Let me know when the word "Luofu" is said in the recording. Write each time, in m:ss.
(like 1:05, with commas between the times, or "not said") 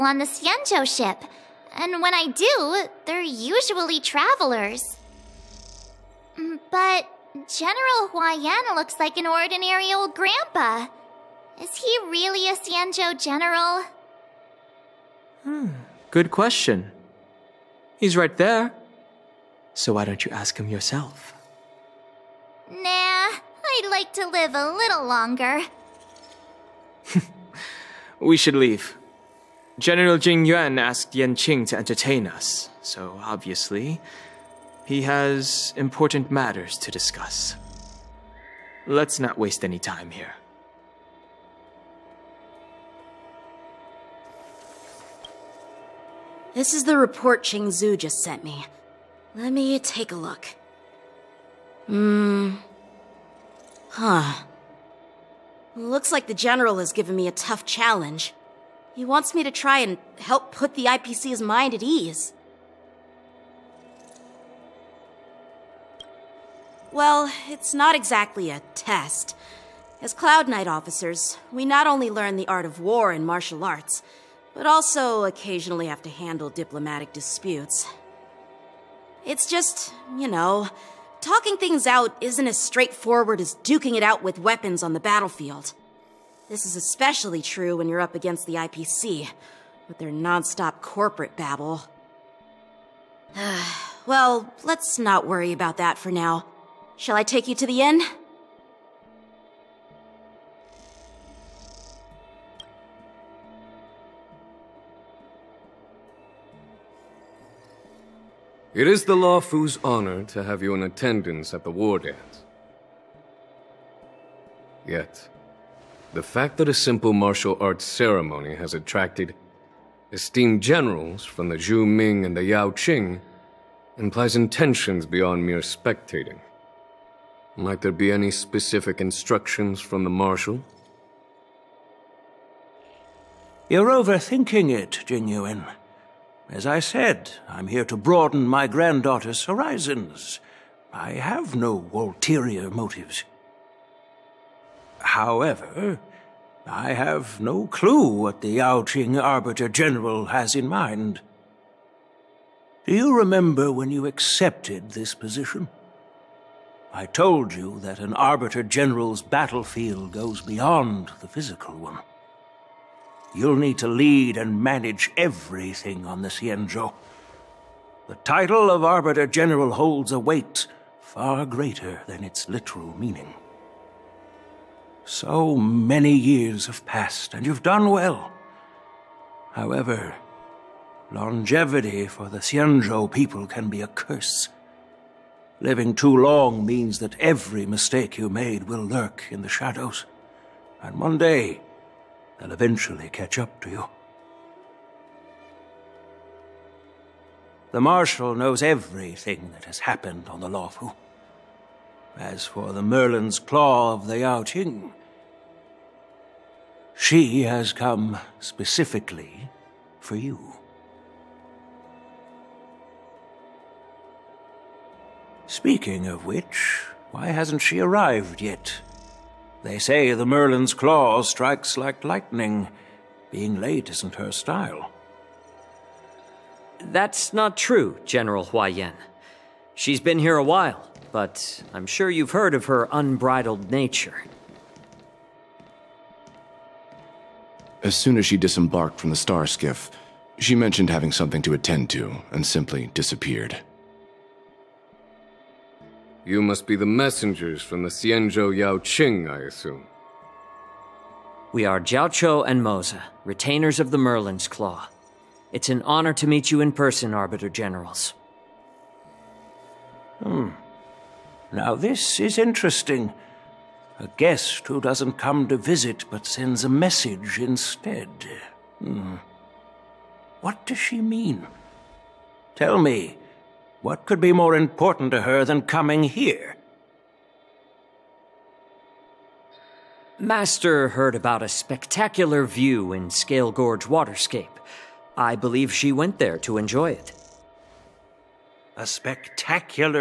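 1:49, 3:20.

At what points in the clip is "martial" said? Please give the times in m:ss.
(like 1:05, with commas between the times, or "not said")
1:13, 1:57.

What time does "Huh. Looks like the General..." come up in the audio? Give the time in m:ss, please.
0:53.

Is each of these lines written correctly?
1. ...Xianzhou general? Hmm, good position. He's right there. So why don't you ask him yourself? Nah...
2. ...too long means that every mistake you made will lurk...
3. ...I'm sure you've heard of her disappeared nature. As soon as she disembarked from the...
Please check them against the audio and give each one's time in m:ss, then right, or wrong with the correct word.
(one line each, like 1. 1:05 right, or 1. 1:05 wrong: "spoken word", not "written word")
1. 0:12 wrong: "question", not "position"
2. 3:05 right
3. 3:51 wrong: "unbridled", not "disappeared".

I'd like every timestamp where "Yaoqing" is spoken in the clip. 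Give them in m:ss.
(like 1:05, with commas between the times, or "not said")
2:02, 2:28, 3:24, 4:08.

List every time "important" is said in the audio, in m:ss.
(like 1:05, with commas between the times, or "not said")
0:35, 4:34.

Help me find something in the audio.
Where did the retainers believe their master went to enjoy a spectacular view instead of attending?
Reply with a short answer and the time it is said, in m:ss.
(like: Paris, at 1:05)
Scalegorge Waterscape, at 4:43.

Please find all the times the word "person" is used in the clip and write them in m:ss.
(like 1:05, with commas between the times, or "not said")
4:16.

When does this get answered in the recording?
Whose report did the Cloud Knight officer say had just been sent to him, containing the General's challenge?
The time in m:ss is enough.
0:47.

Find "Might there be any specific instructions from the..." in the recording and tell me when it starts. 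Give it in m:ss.
2:07.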